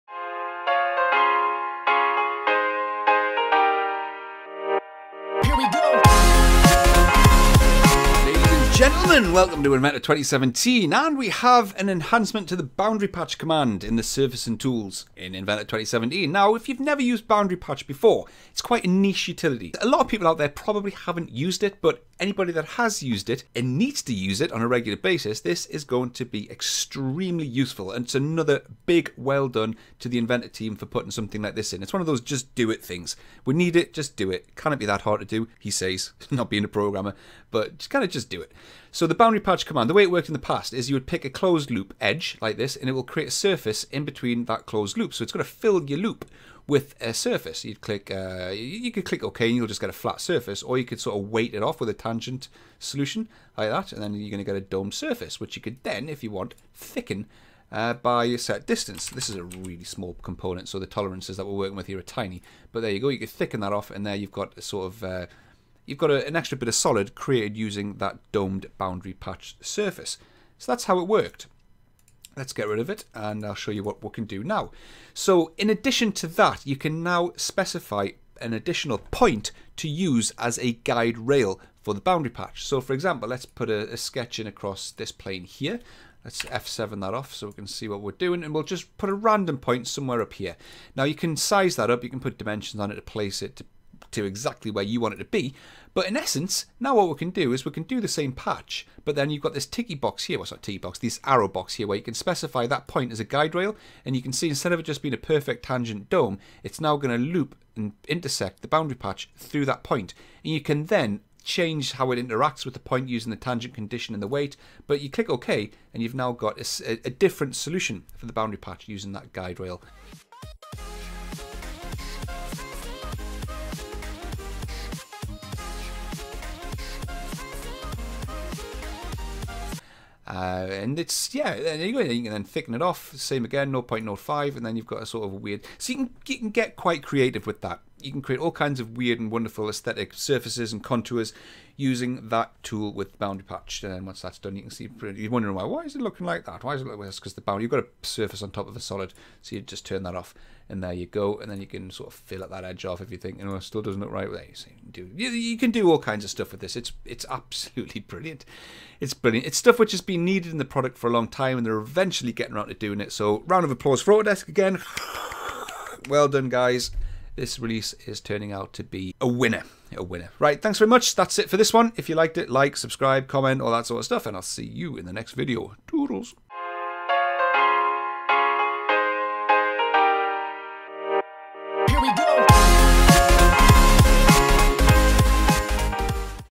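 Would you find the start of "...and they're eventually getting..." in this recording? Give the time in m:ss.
2:41.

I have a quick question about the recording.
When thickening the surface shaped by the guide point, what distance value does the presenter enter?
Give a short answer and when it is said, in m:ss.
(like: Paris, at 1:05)
0.05, at 2:13.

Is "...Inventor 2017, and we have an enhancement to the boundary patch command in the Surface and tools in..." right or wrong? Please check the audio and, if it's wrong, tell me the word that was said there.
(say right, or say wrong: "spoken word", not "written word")
right.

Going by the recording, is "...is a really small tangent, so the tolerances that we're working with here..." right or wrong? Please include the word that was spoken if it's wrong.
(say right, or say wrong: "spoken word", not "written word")
wrong: "component", not "tangent".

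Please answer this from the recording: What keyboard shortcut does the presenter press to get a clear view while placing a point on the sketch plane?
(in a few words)
F7.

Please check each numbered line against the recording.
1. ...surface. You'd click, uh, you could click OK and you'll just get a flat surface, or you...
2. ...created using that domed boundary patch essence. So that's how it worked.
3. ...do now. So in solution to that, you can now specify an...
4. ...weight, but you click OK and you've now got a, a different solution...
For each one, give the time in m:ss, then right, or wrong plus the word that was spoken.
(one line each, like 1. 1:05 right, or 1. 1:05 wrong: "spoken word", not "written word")
1. 0:47 right
2. 1:07 wrong: "surface", not "essence"
3. 1:14 wrong: "addition", not "solution"
4. 1:54 right.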